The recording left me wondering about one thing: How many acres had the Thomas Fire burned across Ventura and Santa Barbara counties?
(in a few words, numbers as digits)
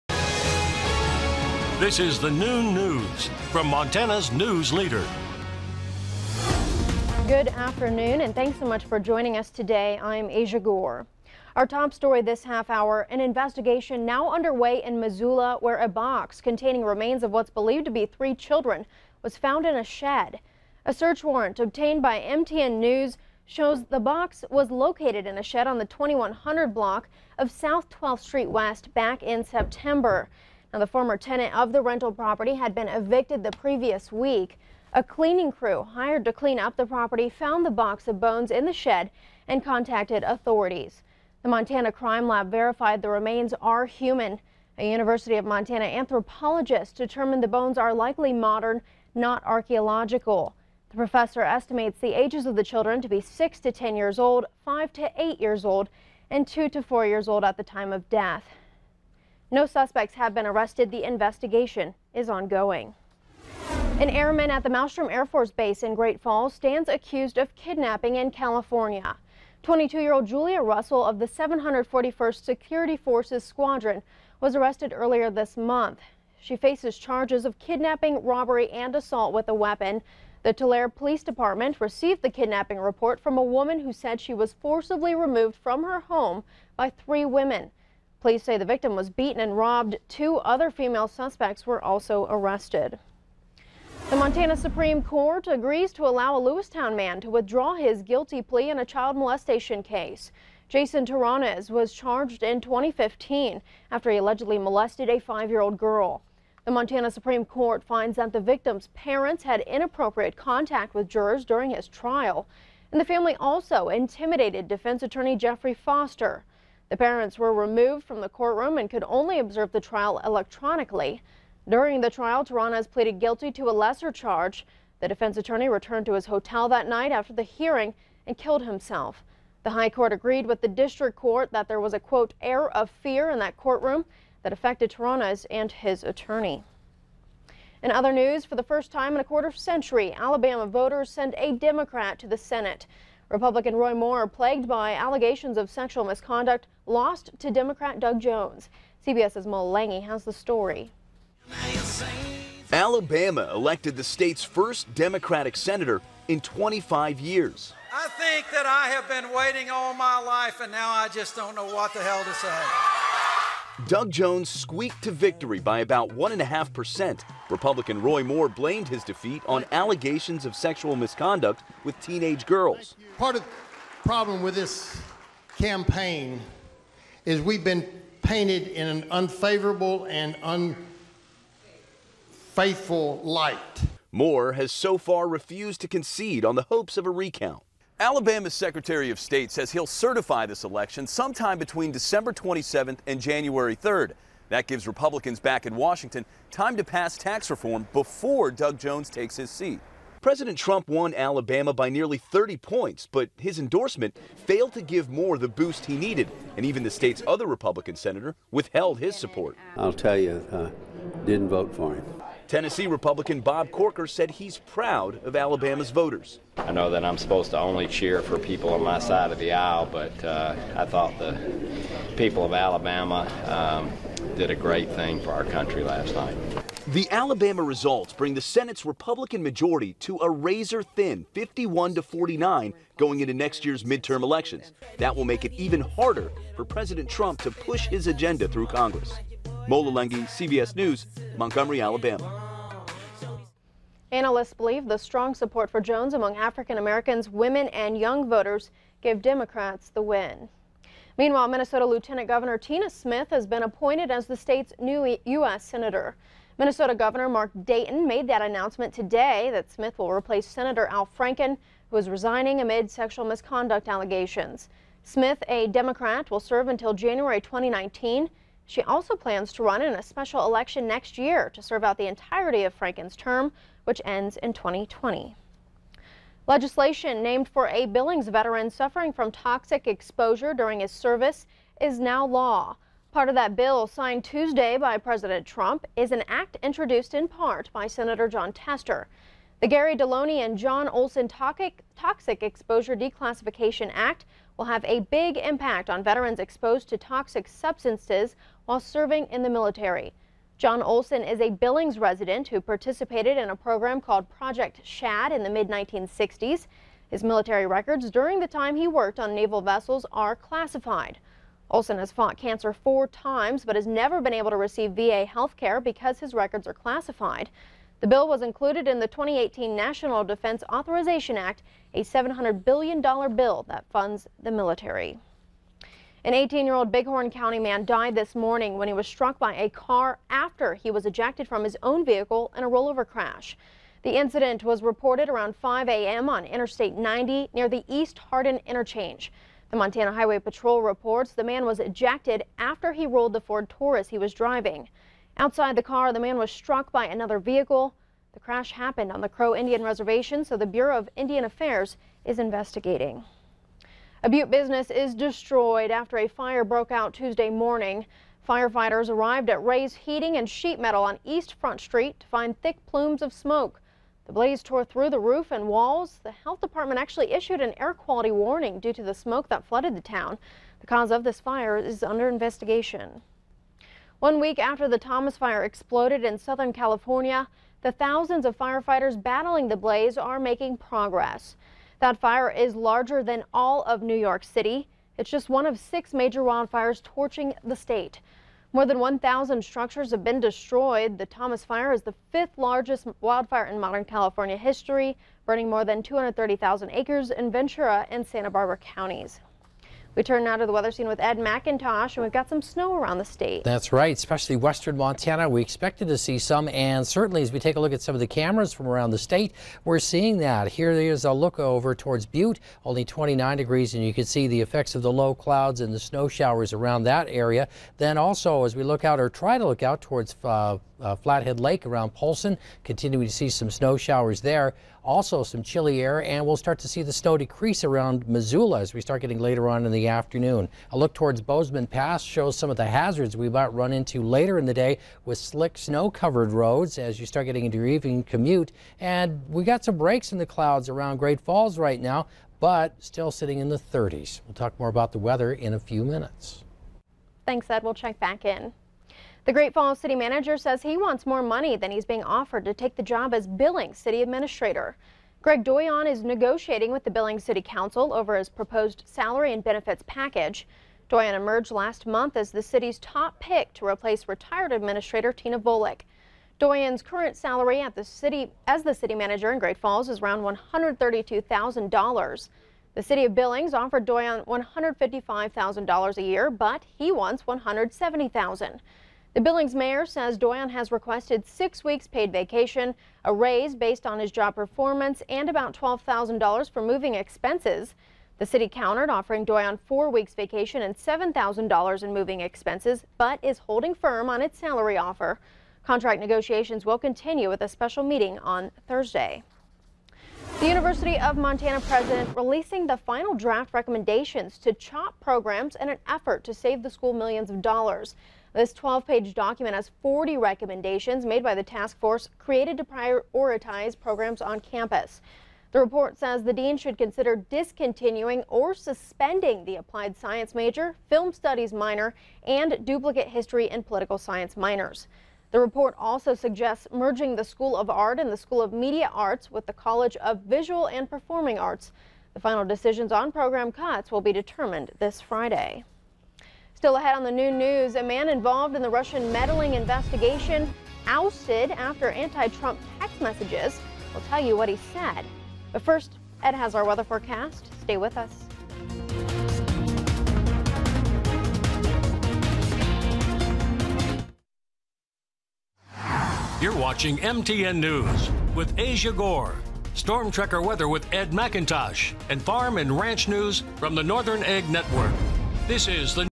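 230,000.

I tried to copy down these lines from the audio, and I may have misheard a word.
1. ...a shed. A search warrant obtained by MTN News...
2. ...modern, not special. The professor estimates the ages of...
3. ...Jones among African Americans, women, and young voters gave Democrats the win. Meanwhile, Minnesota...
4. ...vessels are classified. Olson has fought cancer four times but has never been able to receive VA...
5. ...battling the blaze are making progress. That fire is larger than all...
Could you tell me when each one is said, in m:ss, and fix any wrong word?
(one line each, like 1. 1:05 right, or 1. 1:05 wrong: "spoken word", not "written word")
1. 0:19 right
2. 0:48 wrong: "archaeological", not "special"
3. 4:05 right
4. 5:09 right
5. 6:19 right.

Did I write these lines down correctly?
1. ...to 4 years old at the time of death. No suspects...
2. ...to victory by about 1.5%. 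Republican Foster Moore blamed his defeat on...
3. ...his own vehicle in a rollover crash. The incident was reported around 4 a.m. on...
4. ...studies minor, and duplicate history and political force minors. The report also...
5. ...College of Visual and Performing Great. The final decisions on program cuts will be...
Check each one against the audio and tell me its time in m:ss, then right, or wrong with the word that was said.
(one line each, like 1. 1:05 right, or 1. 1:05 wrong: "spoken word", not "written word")
1. 0:56 right
2. 2:45 wrong: "Roy", not "Foster"
3. 5:31 wrong: "5", not "4"
4. 8:41 wrong: "science", not "force"
5. 8:49 wrong: "Arts", not "Great".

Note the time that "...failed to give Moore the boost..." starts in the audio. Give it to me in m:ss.
3:24.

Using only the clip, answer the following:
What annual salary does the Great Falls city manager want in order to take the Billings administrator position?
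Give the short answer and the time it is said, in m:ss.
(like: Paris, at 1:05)
$170,000, at 7:57.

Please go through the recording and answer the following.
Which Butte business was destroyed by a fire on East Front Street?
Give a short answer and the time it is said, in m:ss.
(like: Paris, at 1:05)
Ray's Heating and Sheet Metal, at 5:59.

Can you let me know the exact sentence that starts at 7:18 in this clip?
And we got some breaks in the clouds around Great Falls right now, but still sitting in the 30s.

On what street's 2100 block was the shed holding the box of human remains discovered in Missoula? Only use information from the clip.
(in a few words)
South 12th Street West.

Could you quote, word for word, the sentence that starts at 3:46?
The Alabama results bring the Senate's Republican majority to a razor thin 51 to 49 going into next year's midterm elections.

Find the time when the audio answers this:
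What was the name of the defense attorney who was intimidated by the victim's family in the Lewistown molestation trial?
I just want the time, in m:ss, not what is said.
1:55.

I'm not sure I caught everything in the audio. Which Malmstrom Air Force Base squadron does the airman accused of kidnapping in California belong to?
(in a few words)
741st Security Forces Squadron.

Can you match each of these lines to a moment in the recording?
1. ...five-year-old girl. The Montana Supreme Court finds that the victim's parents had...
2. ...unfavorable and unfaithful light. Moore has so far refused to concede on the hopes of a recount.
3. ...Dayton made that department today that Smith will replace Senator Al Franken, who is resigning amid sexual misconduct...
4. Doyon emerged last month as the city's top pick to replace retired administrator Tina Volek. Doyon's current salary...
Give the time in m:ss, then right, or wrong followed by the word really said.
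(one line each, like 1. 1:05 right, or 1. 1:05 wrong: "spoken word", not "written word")
1. 1:45 right
2. 2:59 right
3. 4:17 wrong: "announcement", not "department"
4. 7:41 right.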